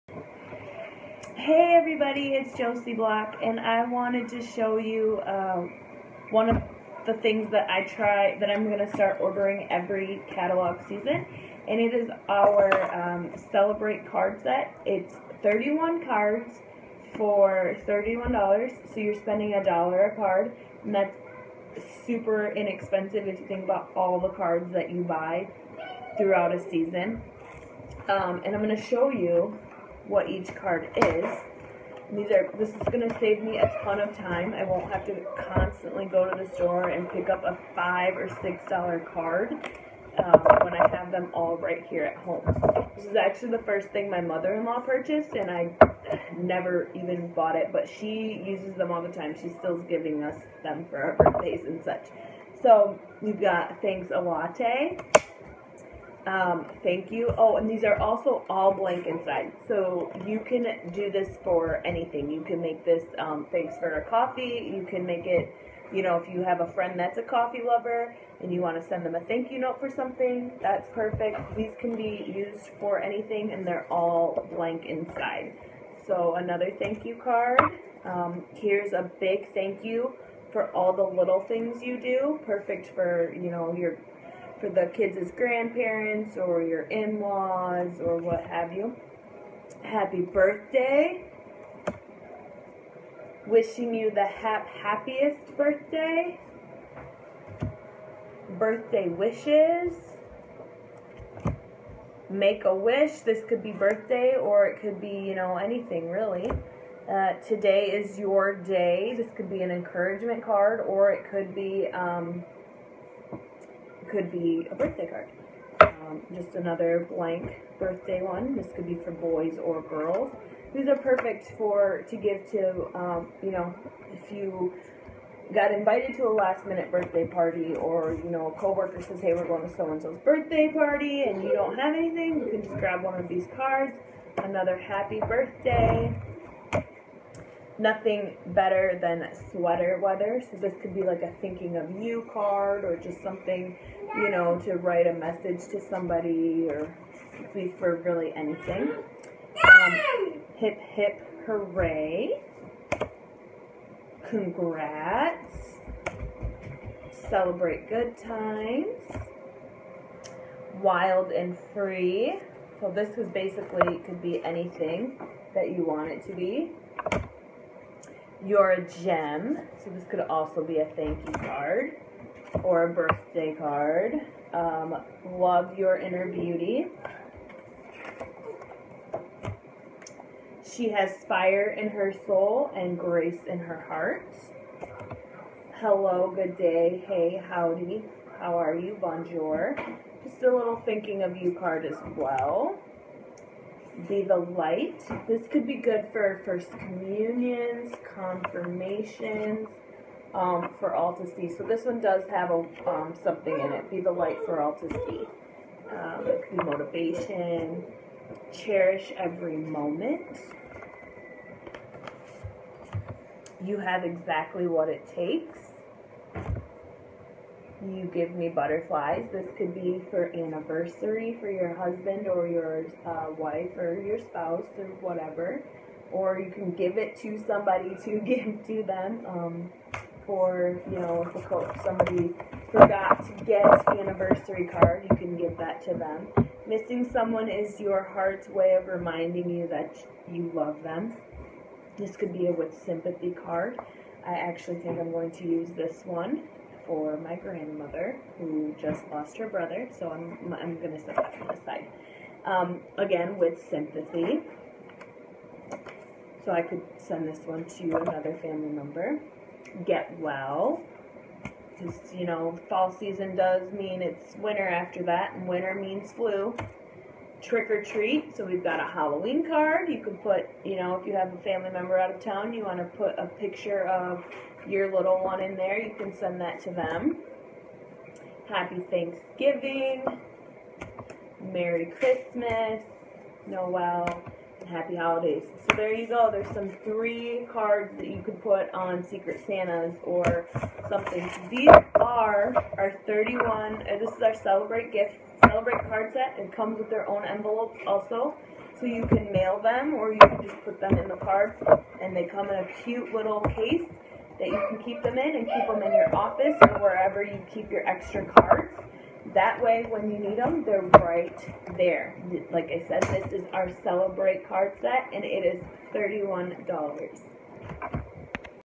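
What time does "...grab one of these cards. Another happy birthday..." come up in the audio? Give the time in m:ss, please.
2:12.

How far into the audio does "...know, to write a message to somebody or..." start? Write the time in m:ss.
2:24.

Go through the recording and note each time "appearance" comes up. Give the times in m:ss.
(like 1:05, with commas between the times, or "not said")
not said.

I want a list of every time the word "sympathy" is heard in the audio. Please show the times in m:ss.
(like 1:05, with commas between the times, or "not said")
4:02, 4:13.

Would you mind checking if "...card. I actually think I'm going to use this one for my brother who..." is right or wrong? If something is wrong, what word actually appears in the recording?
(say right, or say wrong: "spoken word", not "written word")
wrong: "grandmother", not "brother".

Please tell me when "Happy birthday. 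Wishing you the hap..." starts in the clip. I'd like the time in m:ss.
1:29.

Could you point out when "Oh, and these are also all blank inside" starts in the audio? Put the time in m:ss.
0:57.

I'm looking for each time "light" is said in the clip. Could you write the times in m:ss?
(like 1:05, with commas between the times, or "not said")
3:14, 3:24.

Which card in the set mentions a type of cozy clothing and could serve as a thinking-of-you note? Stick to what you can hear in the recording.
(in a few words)
Sweater weather.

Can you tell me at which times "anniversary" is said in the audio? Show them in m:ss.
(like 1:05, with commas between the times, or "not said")
3:40, 3:53.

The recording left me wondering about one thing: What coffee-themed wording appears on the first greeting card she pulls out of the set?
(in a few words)
Thanks a latte.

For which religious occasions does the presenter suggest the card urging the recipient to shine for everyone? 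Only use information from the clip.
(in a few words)
First communions, confirmations.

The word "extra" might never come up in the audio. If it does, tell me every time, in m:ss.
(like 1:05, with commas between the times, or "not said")
5:07.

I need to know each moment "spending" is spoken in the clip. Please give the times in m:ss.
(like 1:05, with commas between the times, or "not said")
0:19.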